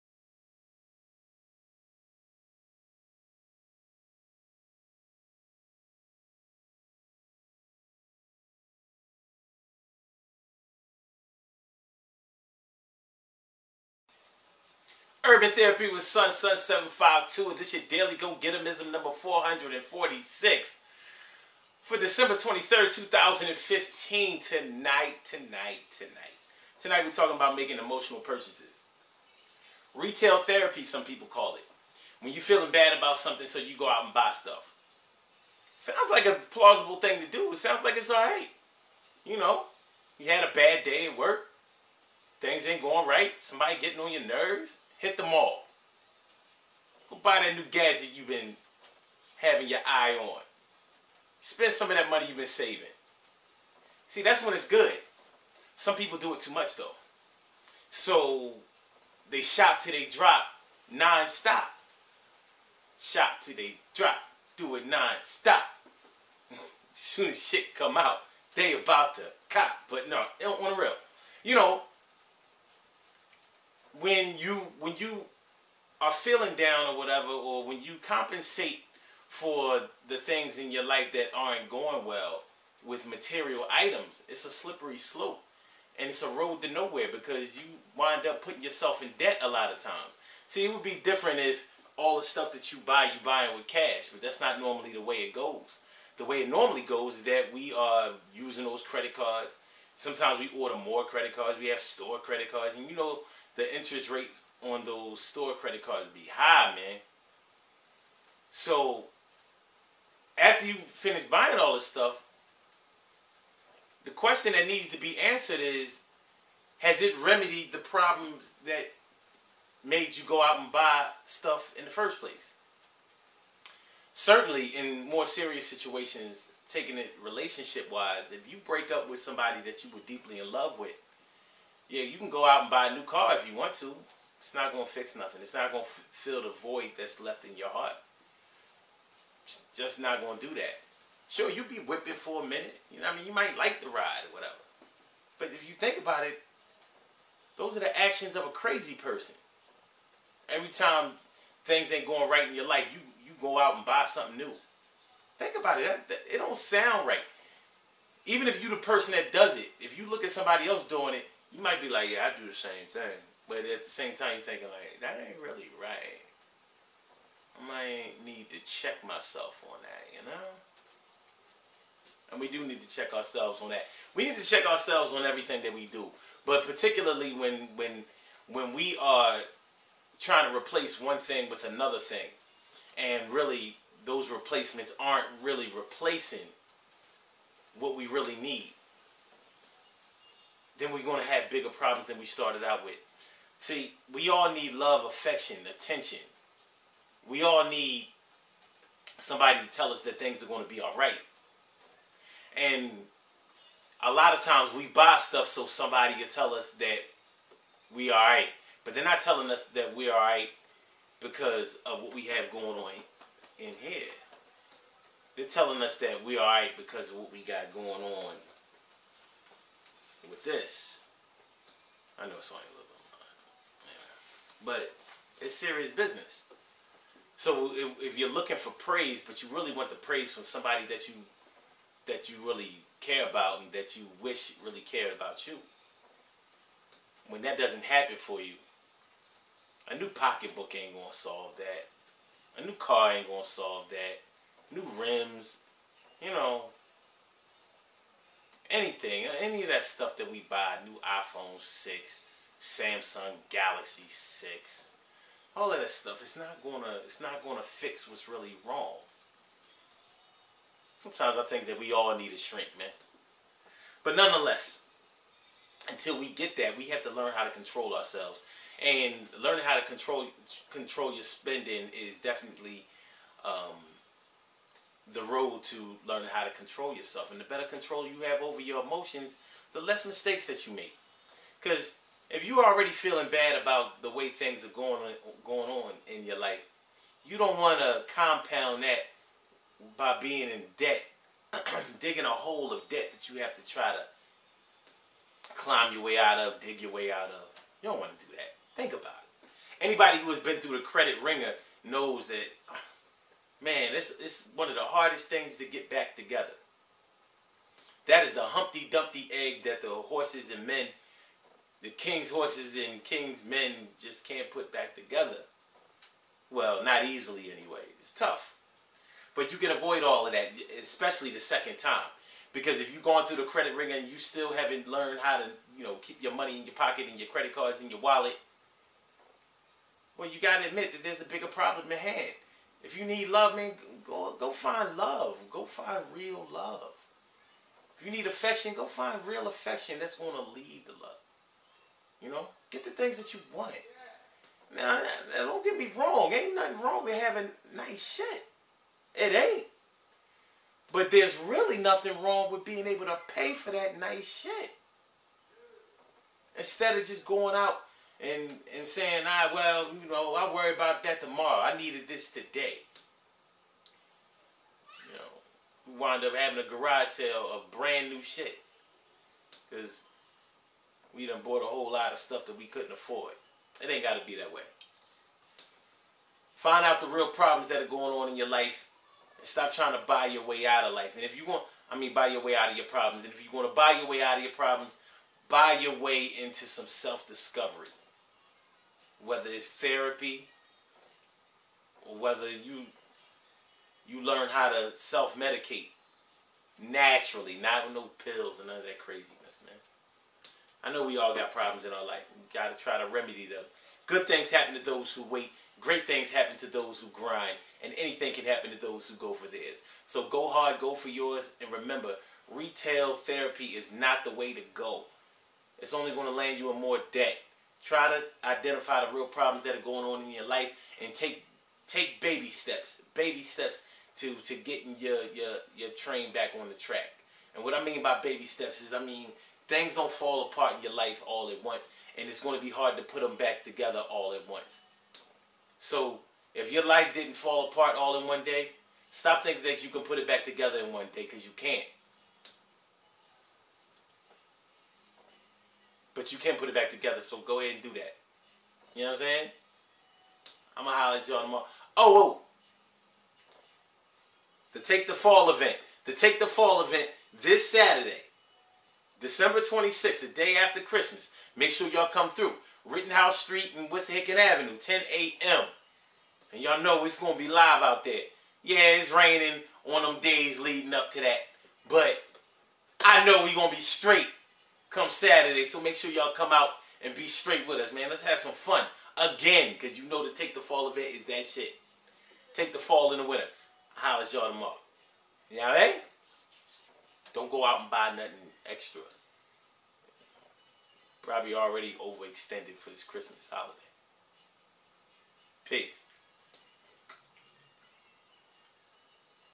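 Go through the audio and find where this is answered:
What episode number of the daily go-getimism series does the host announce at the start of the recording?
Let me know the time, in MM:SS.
00:19.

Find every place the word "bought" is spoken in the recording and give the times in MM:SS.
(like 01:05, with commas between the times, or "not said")
06:11.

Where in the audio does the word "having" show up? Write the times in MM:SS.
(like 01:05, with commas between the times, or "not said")
00:49, 05:47, 06:06.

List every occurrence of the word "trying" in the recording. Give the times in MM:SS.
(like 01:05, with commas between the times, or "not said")
03:00, 06:19.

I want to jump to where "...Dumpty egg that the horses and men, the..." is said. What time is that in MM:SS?
05:08.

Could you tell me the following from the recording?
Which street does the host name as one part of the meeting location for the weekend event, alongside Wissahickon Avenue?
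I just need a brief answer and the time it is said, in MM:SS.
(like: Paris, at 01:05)
Rittenhouse Street, at 07:42.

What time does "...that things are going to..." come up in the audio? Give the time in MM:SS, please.
03:20.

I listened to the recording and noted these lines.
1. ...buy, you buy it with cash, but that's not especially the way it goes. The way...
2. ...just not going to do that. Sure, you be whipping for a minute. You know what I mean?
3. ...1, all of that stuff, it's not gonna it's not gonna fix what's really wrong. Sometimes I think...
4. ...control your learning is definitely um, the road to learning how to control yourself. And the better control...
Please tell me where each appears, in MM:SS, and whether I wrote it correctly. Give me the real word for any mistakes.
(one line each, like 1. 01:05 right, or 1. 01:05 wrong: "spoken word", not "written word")
1. 01:32 wrong: "normally", not "especially"
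2. 02:19 right
3. 04:14 wrong: "6", not "1"
4. 04:30 wrong: "spending", not "learning".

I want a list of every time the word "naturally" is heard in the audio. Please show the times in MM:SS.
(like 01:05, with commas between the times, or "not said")
06:36.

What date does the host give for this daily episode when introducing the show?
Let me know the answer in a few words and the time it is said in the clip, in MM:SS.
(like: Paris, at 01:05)
December 23rd, 2015, at 00:21.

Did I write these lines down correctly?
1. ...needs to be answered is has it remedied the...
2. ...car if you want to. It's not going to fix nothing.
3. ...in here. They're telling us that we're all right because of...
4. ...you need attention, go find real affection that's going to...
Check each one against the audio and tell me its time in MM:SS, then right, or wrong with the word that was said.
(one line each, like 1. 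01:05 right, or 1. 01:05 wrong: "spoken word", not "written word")
1. 01:54 right
2. 02:13 right
3. 03:33 right
4. 05:38 wrong: "affection", not "attention".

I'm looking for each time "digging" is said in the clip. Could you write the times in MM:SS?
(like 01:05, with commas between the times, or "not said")
04:51.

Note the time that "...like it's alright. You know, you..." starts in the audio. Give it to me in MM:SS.
00:37.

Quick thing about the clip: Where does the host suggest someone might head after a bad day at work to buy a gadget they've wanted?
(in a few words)
the mall.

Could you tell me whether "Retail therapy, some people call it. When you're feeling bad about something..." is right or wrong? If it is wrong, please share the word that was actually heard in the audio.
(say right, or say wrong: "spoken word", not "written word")
right.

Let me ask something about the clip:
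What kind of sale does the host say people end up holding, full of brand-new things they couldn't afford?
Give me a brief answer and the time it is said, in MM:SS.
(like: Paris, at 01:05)
garage sale, at 06:06.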